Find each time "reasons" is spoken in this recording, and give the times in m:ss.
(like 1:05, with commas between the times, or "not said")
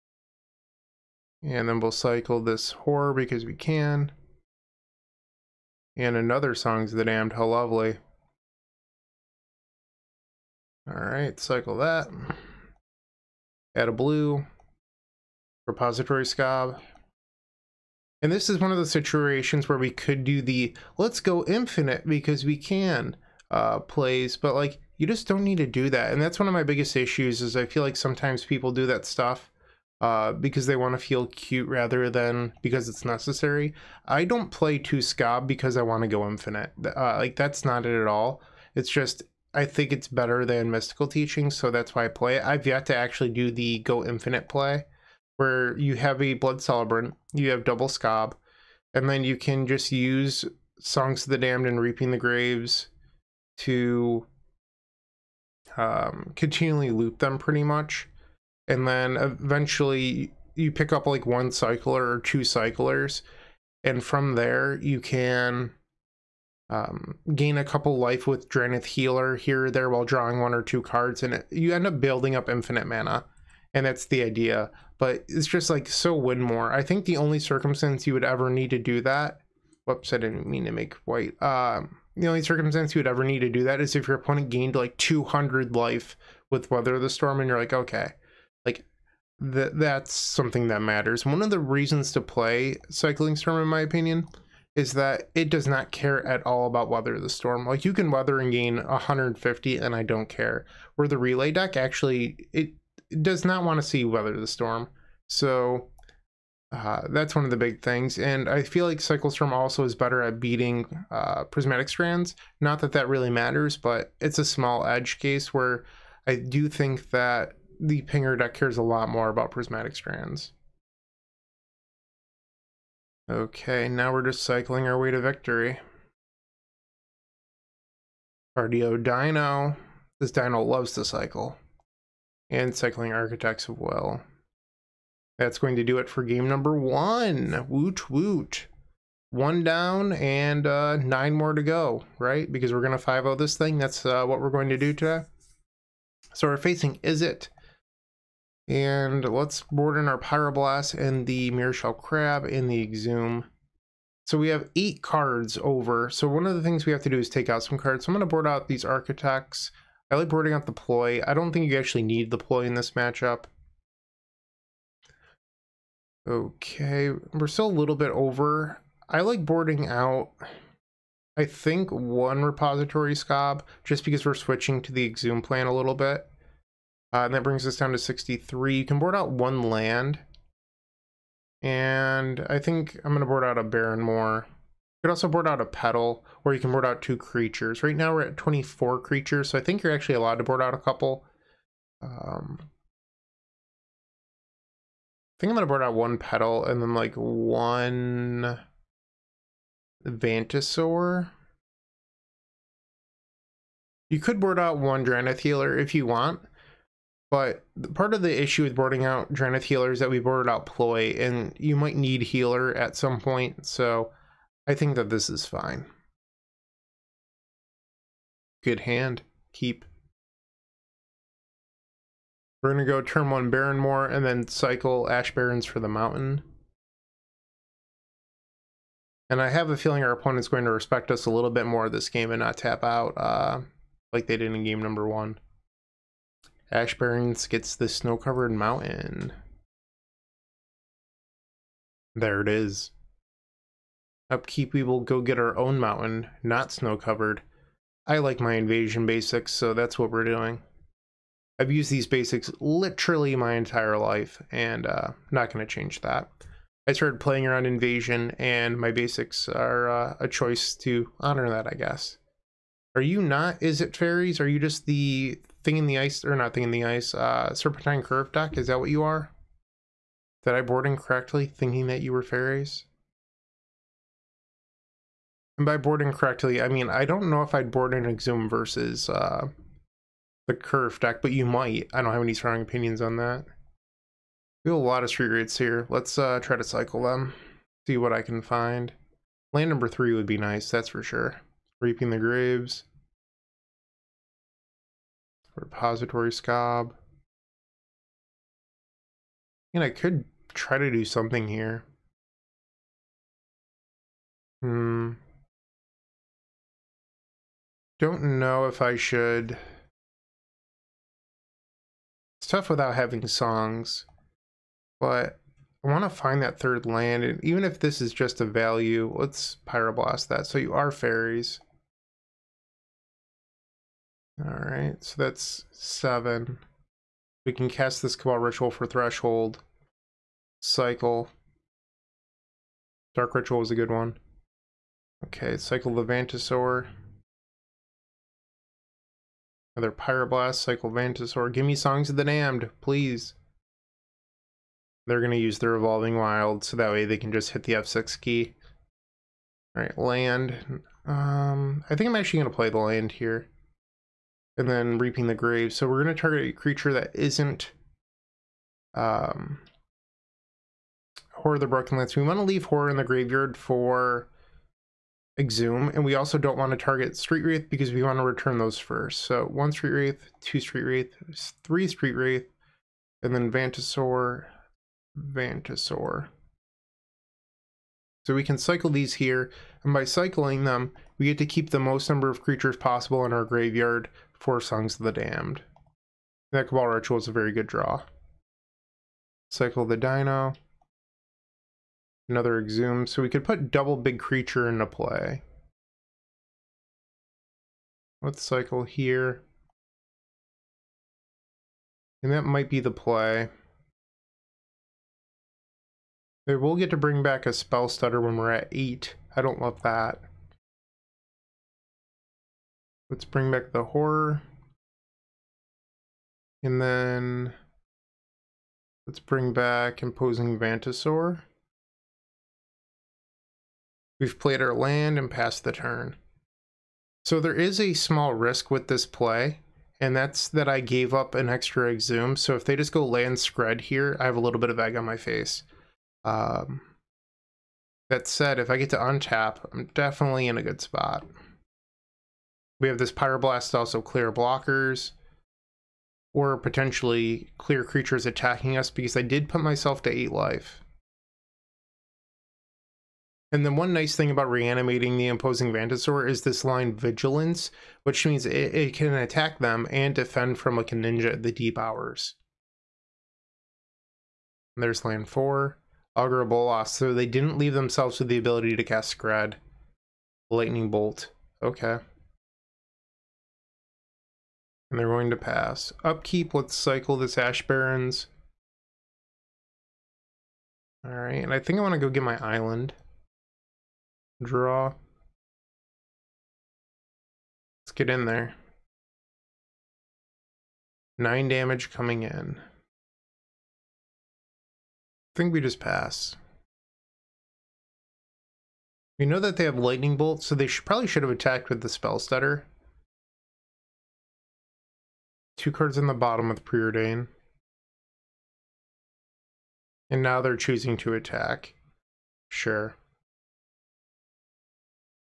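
1:31.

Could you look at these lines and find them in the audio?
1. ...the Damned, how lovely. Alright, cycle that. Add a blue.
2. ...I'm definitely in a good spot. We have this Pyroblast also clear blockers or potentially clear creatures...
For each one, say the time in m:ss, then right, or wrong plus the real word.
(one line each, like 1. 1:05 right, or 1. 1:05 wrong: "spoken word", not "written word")
1. 0:06 right
2. 7:19 right.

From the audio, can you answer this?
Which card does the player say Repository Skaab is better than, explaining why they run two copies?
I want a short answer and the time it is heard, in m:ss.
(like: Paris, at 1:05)
Mystical Teaching, at 0:40.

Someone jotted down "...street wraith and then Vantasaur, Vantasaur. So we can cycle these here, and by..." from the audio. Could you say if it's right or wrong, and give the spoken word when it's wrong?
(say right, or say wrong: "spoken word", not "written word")
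right.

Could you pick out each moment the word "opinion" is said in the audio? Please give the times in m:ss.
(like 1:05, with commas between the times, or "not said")
1:33, 4:42.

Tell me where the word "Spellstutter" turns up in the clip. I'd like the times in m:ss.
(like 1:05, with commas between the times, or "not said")
6:47, 8:21.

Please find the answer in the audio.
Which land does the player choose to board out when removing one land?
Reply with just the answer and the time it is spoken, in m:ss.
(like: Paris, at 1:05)
Barren Moor, at 3:03.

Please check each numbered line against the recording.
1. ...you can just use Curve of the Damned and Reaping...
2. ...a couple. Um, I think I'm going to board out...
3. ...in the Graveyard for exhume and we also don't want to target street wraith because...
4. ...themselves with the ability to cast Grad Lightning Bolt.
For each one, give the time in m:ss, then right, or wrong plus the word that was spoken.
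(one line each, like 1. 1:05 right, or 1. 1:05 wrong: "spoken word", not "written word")
1. 0:49 wrong: "Songs", not "Curve"
2. 3:10 right
3. 6:02 right
4. 7:47 right.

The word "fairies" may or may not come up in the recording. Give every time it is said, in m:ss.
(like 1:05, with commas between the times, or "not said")
4:23, 4:32, 5:20.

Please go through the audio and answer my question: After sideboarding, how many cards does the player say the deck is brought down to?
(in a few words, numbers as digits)
63.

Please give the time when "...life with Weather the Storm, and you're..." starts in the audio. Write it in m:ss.
1:25.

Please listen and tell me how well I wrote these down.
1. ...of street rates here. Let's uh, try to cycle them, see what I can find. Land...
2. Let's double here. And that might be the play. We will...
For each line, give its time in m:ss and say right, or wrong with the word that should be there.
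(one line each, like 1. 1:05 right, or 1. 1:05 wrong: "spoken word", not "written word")
1. 4:45 right
2. 6:38 wrong: "cycle", not "double".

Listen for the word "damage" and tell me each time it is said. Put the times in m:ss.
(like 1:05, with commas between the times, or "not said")
8:11.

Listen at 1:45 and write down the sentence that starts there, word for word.
So uh, that's one of the big things.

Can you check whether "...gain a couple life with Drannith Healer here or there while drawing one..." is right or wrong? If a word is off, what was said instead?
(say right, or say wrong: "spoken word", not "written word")
right.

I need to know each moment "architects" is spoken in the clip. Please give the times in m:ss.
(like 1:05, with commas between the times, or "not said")
2:13, 2:38.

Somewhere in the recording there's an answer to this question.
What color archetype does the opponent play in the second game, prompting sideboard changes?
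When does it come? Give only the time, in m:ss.
2:26.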